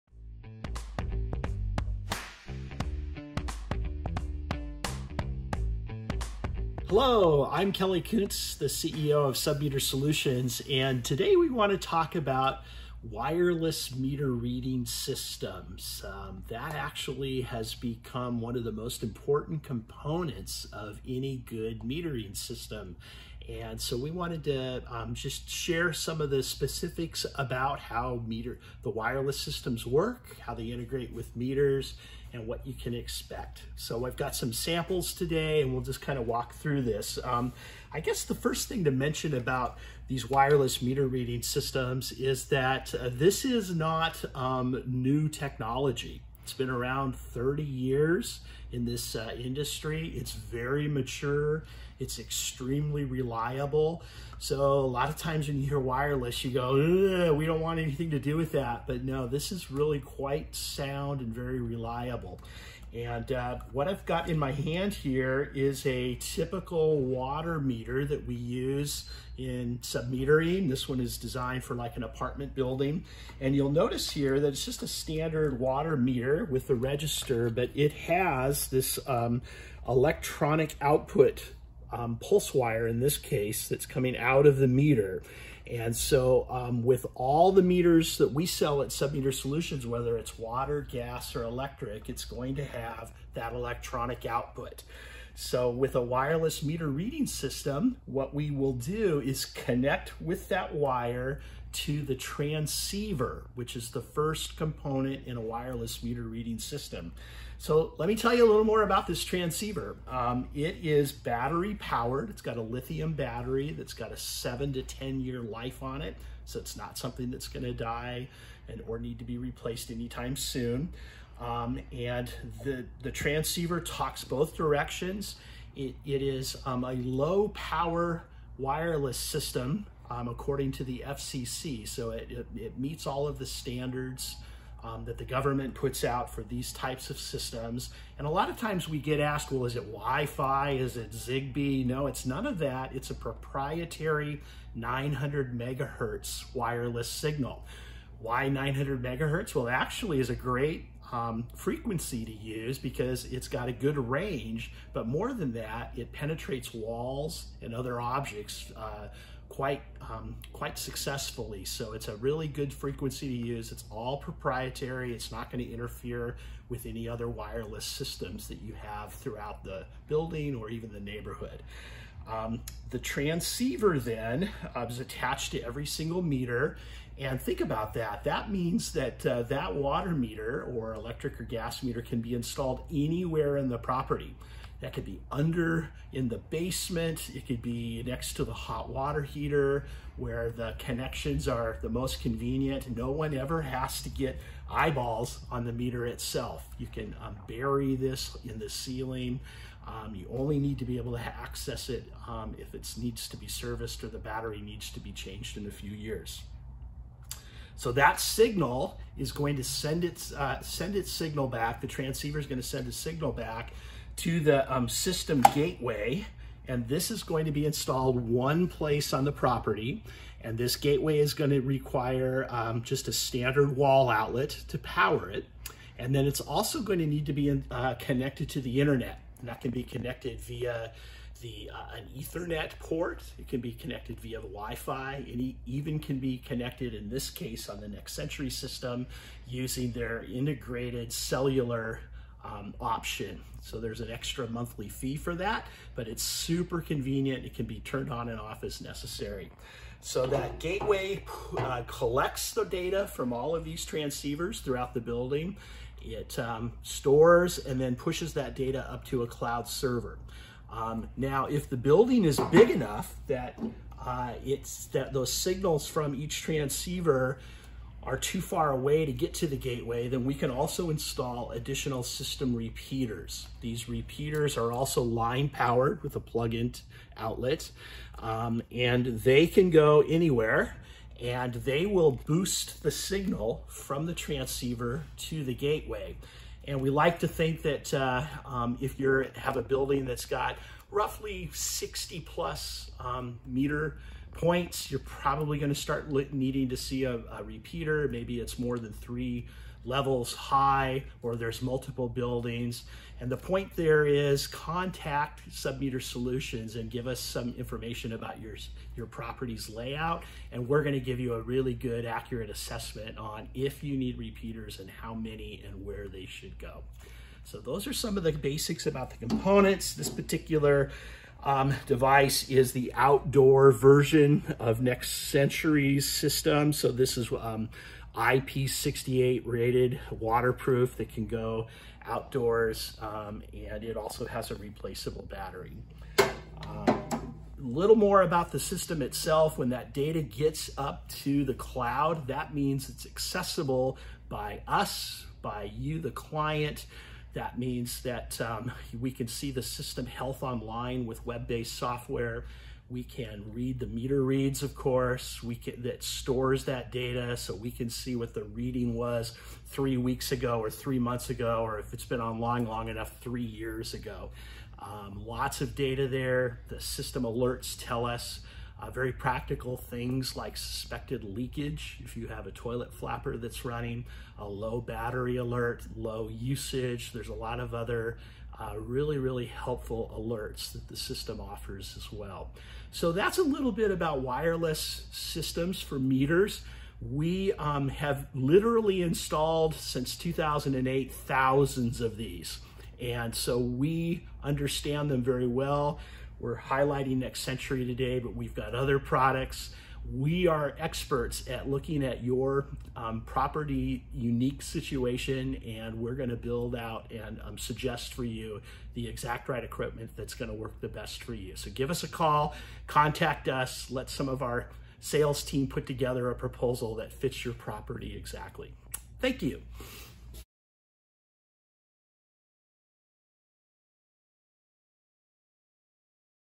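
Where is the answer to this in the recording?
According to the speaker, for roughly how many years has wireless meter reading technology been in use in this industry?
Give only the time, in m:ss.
0:47.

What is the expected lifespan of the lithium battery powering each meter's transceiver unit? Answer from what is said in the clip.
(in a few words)
7 to 10 years.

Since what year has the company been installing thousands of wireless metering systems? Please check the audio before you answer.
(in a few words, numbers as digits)
2008.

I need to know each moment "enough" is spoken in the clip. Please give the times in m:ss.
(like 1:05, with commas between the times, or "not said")
4:22, 6:02.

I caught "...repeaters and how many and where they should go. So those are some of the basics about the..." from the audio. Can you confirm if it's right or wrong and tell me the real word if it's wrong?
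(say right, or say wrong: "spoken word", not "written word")
right.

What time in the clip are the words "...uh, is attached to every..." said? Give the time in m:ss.
2:54.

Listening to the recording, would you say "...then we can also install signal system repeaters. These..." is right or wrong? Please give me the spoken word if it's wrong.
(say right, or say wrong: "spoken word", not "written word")
wrong: "additional", not "signal".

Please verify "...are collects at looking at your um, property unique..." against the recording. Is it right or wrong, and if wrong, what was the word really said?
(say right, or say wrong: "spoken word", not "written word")
wrong: "experts", not "collects".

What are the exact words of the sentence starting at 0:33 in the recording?
So I've got some samples today and we'll just kind of walk through this.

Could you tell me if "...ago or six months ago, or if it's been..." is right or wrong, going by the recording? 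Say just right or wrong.
wrong.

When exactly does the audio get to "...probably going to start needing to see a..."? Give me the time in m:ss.
4:55.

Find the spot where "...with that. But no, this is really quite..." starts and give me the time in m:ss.
0:58.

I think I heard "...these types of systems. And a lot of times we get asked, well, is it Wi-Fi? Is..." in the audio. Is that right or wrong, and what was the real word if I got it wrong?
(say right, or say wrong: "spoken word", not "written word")
right.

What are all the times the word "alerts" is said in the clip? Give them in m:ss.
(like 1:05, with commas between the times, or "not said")
6:07, 6:15, 6:20.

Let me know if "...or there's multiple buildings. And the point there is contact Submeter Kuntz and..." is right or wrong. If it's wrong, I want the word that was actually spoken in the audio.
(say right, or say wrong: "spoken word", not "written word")
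wrong: "Solutions", not "Kuntz".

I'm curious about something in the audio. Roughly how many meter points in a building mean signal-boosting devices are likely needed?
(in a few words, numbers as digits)
60 plus.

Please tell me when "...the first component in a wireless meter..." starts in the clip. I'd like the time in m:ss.
1:43.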